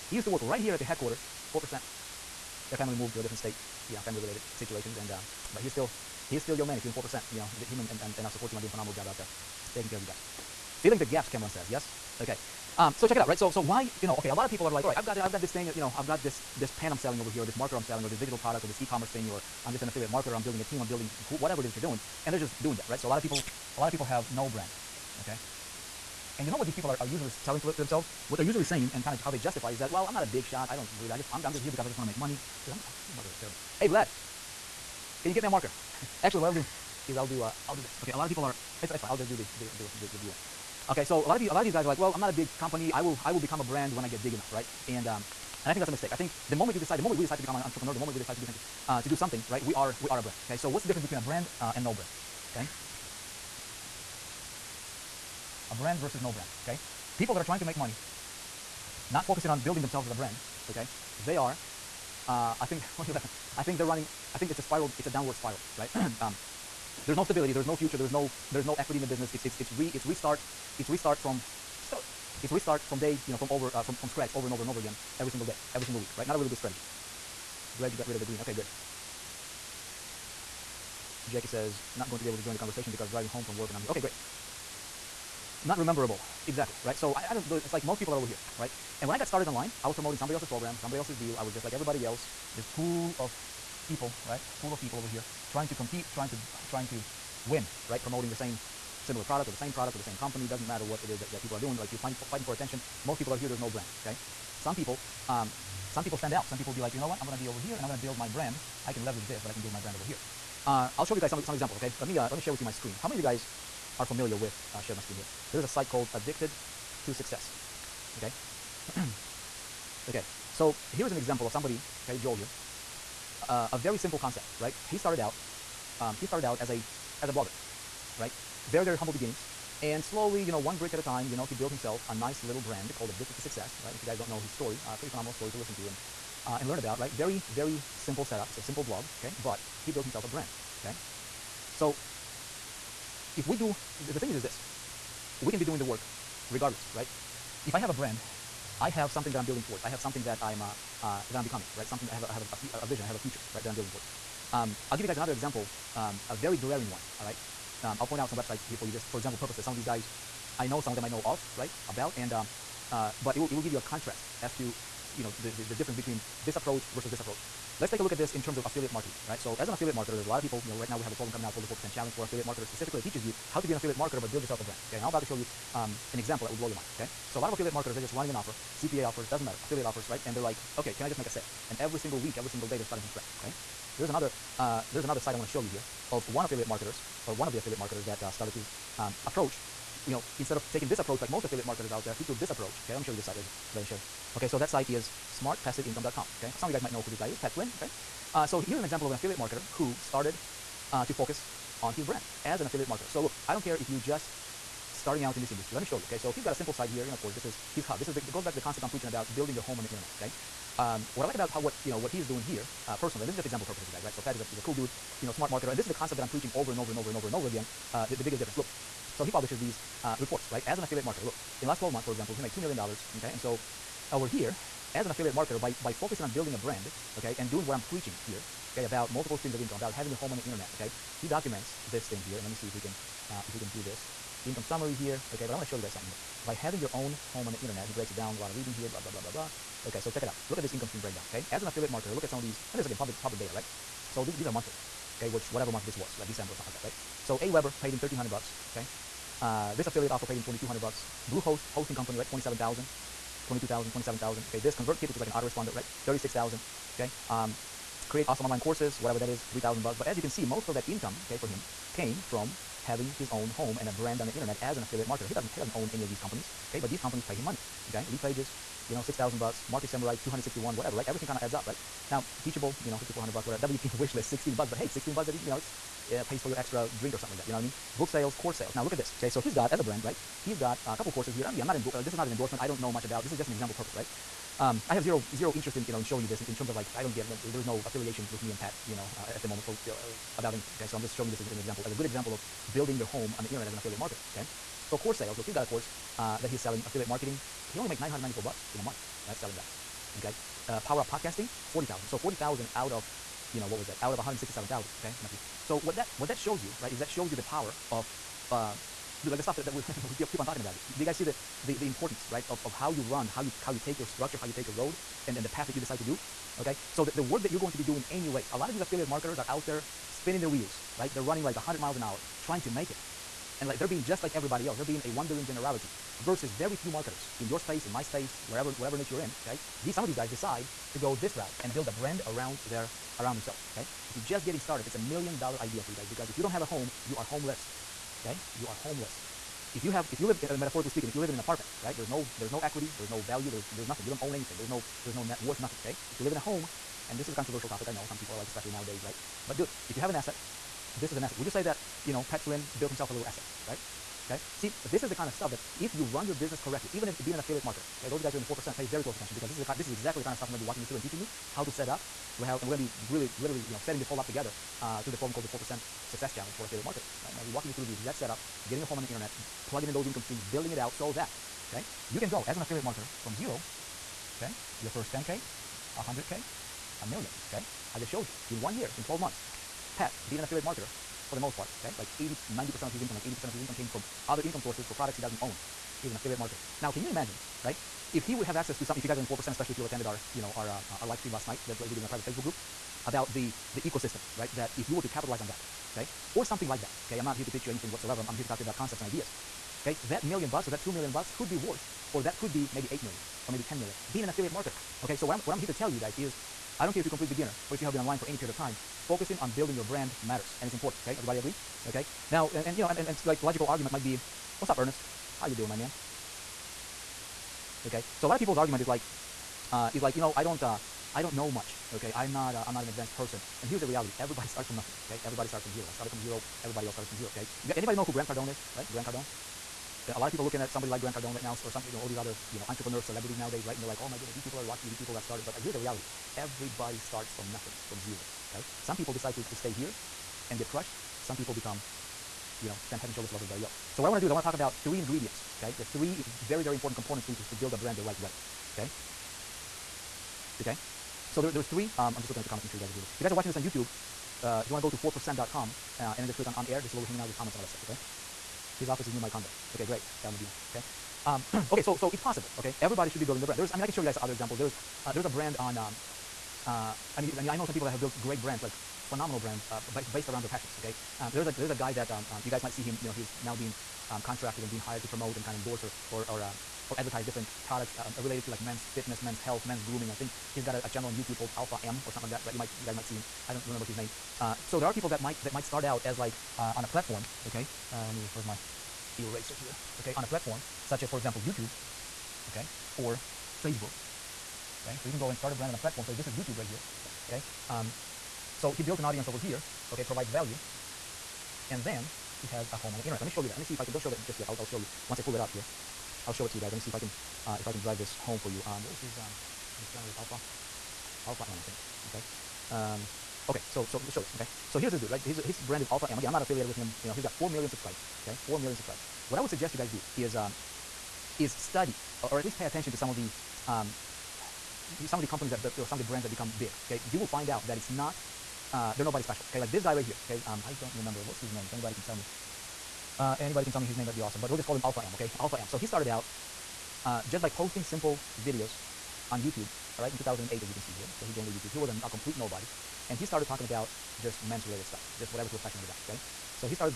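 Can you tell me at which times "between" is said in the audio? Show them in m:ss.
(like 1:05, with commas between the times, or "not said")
0:51, 2:45.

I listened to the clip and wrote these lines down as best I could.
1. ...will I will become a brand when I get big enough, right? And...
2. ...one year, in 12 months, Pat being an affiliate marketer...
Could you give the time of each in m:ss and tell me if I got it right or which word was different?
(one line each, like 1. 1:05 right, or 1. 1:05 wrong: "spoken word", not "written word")
1. 0:43 right
2. 6:18 right.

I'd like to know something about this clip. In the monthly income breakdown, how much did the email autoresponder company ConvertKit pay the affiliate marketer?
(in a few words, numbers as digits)
36,000.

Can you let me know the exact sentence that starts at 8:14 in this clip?
Okay, so you can go and start a brand on a platform.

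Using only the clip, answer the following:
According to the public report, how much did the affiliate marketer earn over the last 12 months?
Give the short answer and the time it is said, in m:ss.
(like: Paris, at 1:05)
$2 million, at 3:42.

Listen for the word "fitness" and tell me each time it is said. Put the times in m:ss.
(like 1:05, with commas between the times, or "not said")
7:58.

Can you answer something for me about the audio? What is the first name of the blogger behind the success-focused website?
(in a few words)
Joel.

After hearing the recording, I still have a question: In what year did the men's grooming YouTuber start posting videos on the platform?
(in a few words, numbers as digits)
2008.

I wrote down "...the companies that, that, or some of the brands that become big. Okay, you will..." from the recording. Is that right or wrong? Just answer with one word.
right.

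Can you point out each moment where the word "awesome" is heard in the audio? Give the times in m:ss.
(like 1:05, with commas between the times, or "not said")
4:18, 8:54.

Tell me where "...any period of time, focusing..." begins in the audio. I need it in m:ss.
6:48.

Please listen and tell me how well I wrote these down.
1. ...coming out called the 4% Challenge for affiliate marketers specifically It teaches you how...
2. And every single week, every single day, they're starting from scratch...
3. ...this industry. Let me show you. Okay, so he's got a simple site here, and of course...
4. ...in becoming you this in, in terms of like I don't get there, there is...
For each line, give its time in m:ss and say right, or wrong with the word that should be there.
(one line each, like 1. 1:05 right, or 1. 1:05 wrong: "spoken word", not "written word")
1. 2:51 right
2. 3:01 right
3. 3:25 right
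4. 4:45 wrong: "showing", not "becoming".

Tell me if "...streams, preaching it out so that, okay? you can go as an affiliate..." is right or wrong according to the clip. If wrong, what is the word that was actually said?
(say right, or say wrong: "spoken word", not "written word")
wrong: "building", not "preaching".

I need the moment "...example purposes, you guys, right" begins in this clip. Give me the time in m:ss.
3:33.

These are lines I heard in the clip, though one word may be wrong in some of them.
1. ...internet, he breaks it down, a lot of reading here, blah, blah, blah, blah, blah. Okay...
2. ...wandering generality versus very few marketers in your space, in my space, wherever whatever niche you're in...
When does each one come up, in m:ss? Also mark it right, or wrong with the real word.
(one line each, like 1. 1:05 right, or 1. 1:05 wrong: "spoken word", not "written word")
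1. 3:57 right
2. 5:25 right.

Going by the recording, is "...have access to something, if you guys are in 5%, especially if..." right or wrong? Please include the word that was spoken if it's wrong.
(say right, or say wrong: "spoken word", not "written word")
wrong: "4", not "5".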